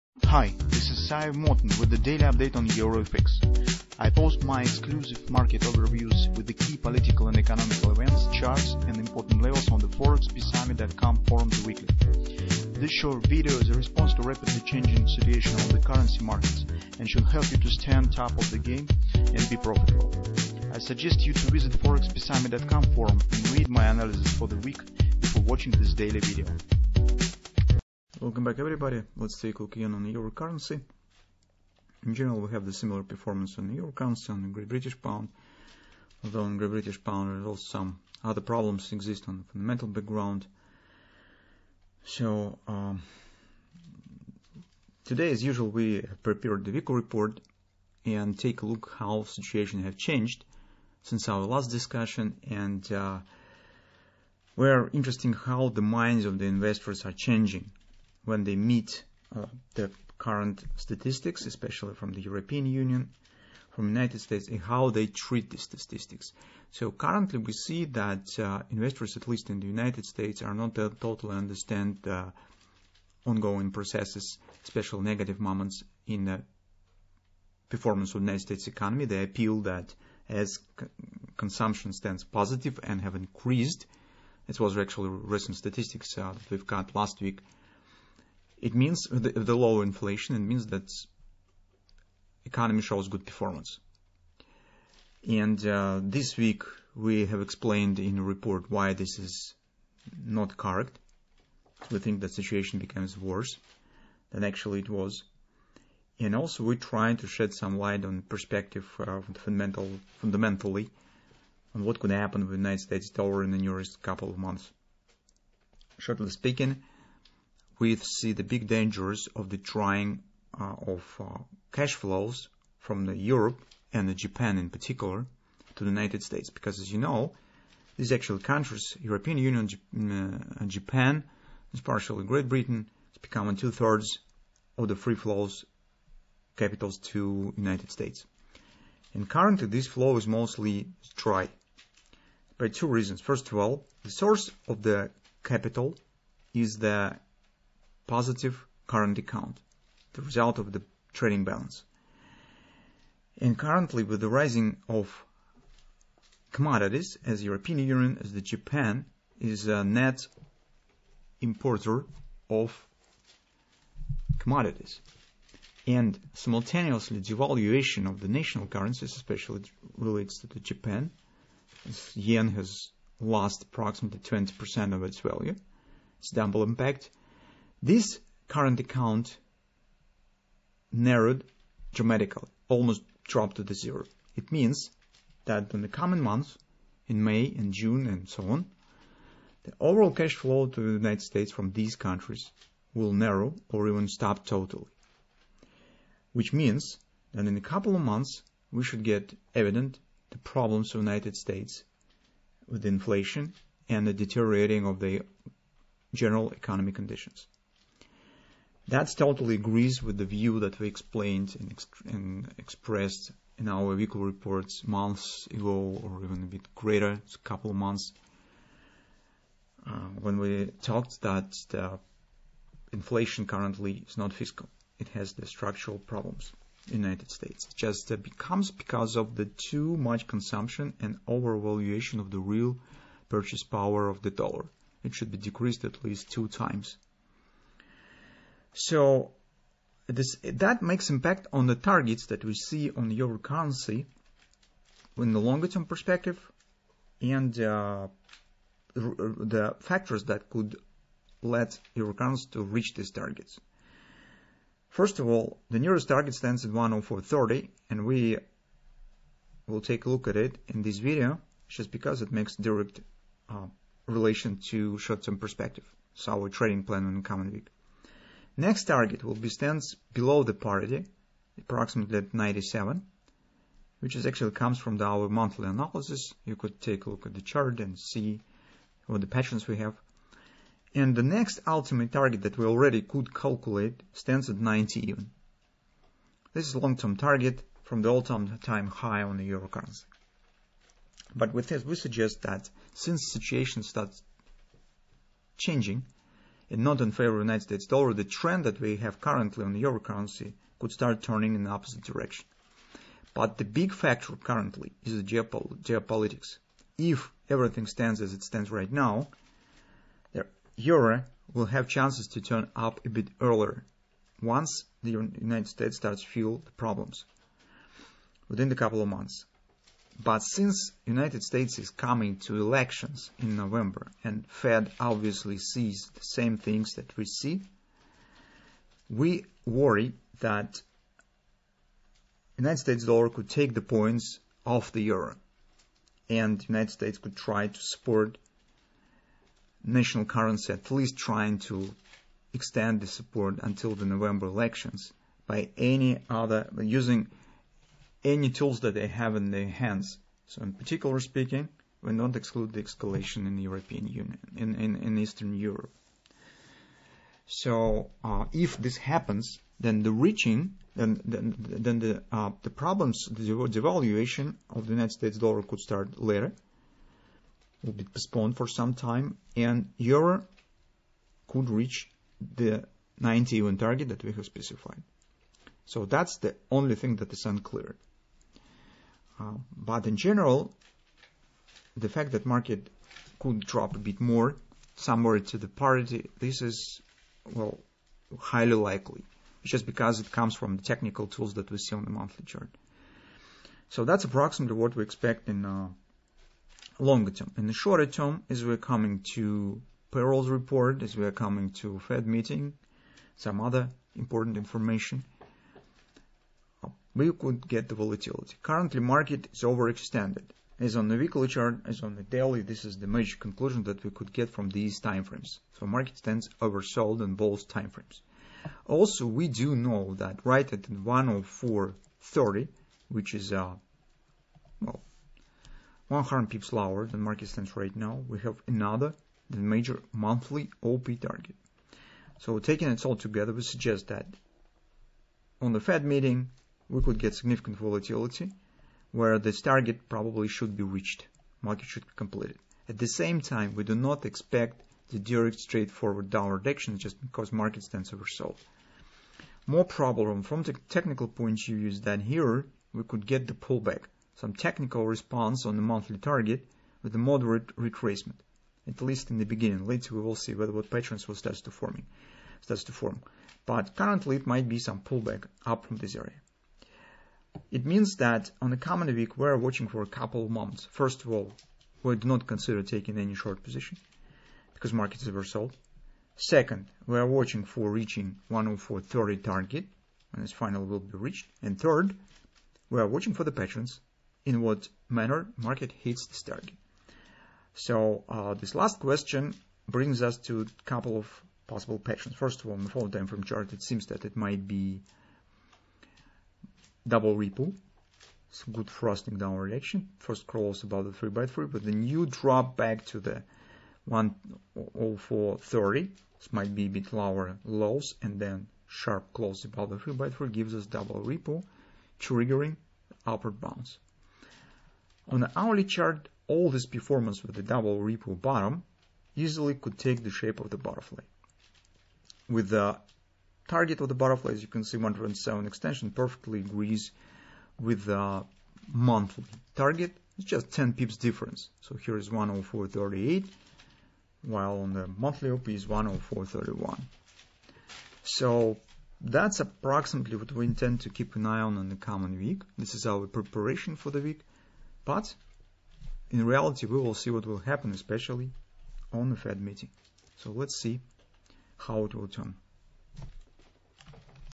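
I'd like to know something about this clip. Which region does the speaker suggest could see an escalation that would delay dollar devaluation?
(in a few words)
Eastern Europe.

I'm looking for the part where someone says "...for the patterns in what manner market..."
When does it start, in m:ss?
8:03.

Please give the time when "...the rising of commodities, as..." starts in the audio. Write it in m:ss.
2:34.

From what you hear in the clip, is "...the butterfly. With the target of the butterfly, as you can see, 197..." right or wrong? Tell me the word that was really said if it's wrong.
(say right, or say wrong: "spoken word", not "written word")
wrong: "107", not "197".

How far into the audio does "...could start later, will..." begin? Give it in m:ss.
6:05.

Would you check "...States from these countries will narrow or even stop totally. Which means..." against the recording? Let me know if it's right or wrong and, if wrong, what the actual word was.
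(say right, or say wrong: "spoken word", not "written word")
right.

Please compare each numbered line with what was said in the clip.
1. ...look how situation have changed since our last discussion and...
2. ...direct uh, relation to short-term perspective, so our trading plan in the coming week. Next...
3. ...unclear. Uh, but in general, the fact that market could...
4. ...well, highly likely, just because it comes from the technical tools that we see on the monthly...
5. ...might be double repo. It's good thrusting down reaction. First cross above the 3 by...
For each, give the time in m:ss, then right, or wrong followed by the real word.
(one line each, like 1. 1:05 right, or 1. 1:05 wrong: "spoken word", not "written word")
1. 0:48 right
2. 4:22 right
3. 6:17 right
4. 6:27 right
5. 8:14 right.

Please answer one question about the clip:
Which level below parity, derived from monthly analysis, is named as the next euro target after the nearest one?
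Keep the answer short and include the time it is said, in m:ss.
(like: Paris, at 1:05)
97, at 4:32.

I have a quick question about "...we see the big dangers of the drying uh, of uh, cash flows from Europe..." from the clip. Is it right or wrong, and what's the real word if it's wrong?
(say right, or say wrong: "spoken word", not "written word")
right.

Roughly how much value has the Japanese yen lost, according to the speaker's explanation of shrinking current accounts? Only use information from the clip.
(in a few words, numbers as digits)
20%.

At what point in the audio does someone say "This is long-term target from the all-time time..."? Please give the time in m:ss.
4:46.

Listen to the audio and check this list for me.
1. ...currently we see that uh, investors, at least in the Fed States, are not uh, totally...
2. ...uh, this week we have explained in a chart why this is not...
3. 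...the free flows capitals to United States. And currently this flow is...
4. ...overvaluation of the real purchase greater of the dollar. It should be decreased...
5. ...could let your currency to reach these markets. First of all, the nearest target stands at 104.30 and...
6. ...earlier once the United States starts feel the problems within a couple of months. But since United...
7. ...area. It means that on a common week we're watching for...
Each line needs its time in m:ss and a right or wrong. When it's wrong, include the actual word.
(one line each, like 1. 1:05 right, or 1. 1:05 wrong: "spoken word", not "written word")
1. 1:06 wrong: "United", not "Fed"
2. 1:35 wrong: "report", not "chart"
3. 2:14 right
4. 3:51 wrong: "power", not "greater"
5. 4:10 wrong: "targets", not "markets"
6. 5:13 right
7. 7:46 right.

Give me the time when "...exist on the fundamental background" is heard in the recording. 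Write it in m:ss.
0:38.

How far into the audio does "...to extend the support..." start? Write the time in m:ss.
5:41.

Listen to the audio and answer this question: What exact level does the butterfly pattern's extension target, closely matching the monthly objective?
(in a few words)
104.38.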